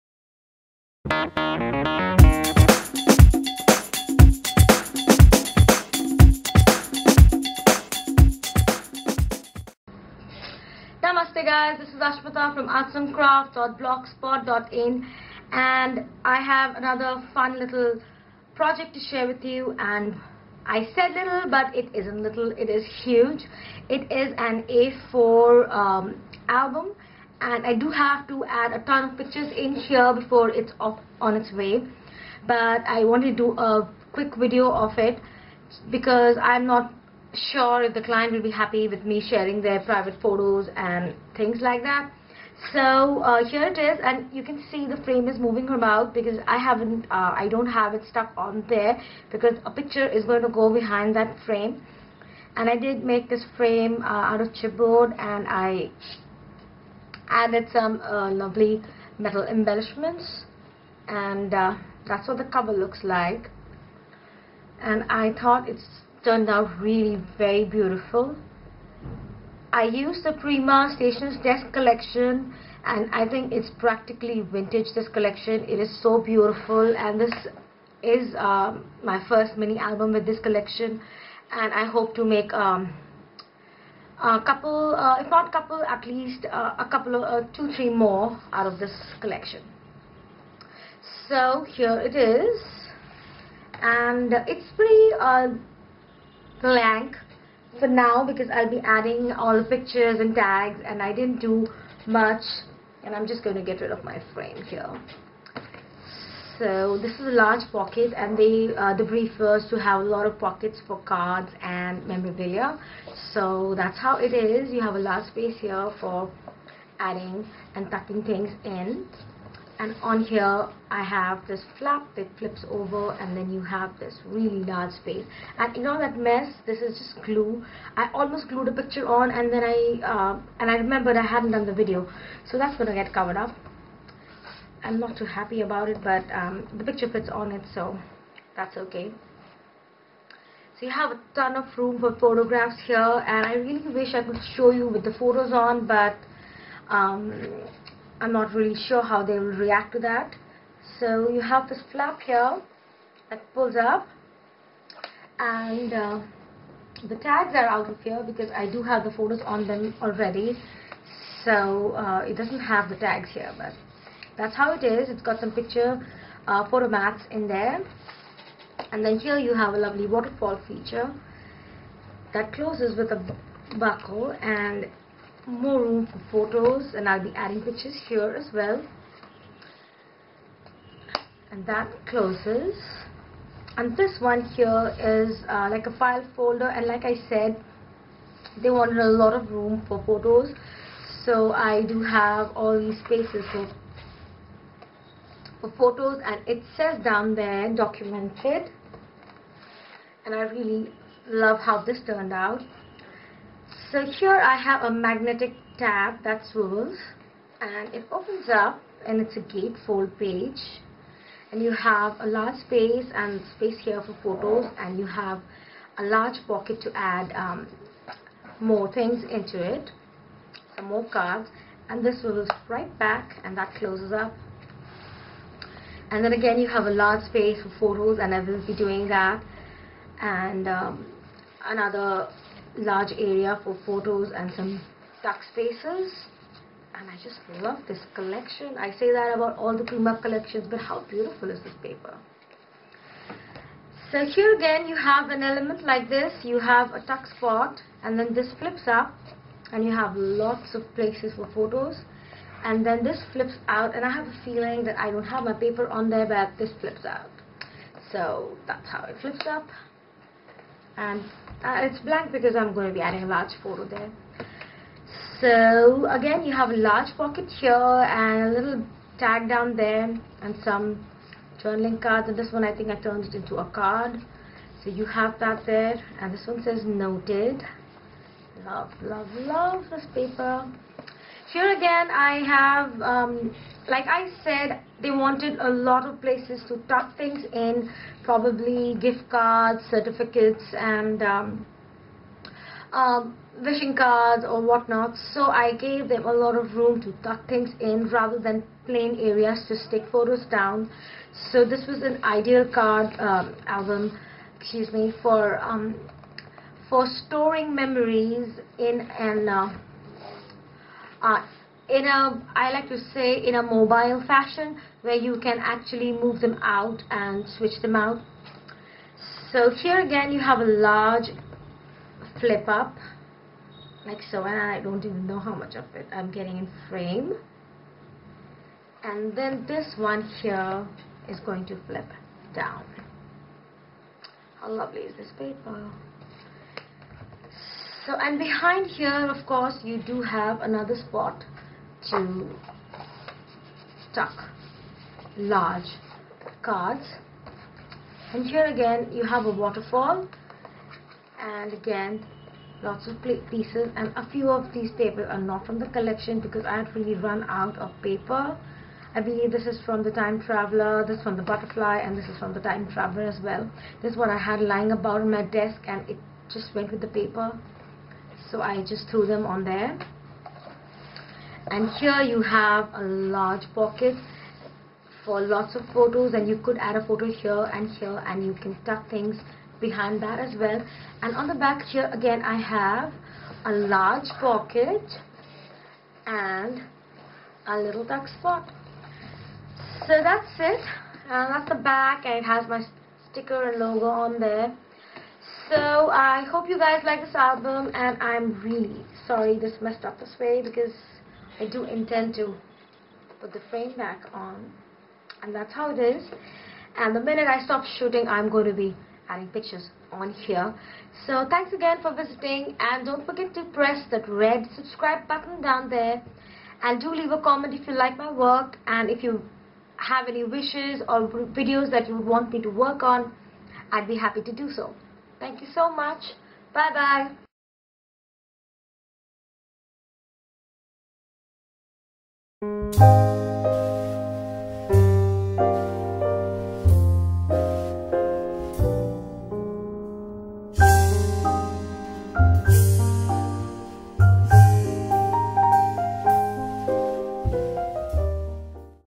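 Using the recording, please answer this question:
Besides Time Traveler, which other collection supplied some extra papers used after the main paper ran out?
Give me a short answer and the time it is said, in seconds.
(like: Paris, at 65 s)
Butterfly, at 361 s.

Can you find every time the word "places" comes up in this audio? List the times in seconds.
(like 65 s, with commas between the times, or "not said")
250 s, 286 s.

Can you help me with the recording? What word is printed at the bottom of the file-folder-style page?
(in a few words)
documented.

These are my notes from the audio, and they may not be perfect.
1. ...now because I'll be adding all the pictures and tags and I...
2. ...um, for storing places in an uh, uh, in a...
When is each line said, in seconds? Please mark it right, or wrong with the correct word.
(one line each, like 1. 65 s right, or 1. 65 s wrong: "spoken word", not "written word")
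1. 97 s right
2. 305 s wrong: "memories", not "places".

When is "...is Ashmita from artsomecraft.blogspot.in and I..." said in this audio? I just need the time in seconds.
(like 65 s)
11 s.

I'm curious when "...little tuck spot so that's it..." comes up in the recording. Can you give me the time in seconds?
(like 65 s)
387 s.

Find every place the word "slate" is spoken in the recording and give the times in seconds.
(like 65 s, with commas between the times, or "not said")
not said.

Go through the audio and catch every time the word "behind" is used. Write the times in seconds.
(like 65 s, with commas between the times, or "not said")
50 s, 338 s, 379 s.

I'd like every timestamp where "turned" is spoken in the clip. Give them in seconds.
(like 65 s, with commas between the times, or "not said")
66 s, 202 s, 272 s.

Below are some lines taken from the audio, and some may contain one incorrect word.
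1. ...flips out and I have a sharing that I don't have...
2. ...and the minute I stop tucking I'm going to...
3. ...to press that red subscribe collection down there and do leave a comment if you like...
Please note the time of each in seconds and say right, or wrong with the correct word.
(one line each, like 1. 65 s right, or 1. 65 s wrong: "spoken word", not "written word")
1. 253 s wrong: "feeling", not "sharing"
2. 406 s wrong: "shooting", not "tucking"
3. 413 s wrong: "button", not "collection".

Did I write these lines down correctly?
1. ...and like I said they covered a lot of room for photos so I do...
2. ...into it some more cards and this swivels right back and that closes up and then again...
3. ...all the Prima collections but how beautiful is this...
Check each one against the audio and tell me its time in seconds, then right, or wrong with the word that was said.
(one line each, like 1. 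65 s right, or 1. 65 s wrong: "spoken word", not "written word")
1. 186 s wrong: "wanted", not "covered"
2. 219 s right
3. 239 s right.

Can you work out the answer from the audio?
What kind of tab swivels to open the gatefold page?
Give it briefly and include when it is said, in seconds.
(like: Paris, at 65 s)
magnetic, at 204 s.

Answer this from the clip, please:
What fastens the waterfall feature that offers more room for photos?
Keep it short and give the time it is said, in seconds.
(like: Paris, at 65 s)
a buckle, at 173 s.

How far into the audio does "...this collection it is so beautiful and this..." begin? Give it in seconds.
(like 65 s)
74 s.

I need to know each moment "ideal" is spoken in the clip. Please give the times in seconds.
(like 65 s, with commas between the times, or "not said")
302 s.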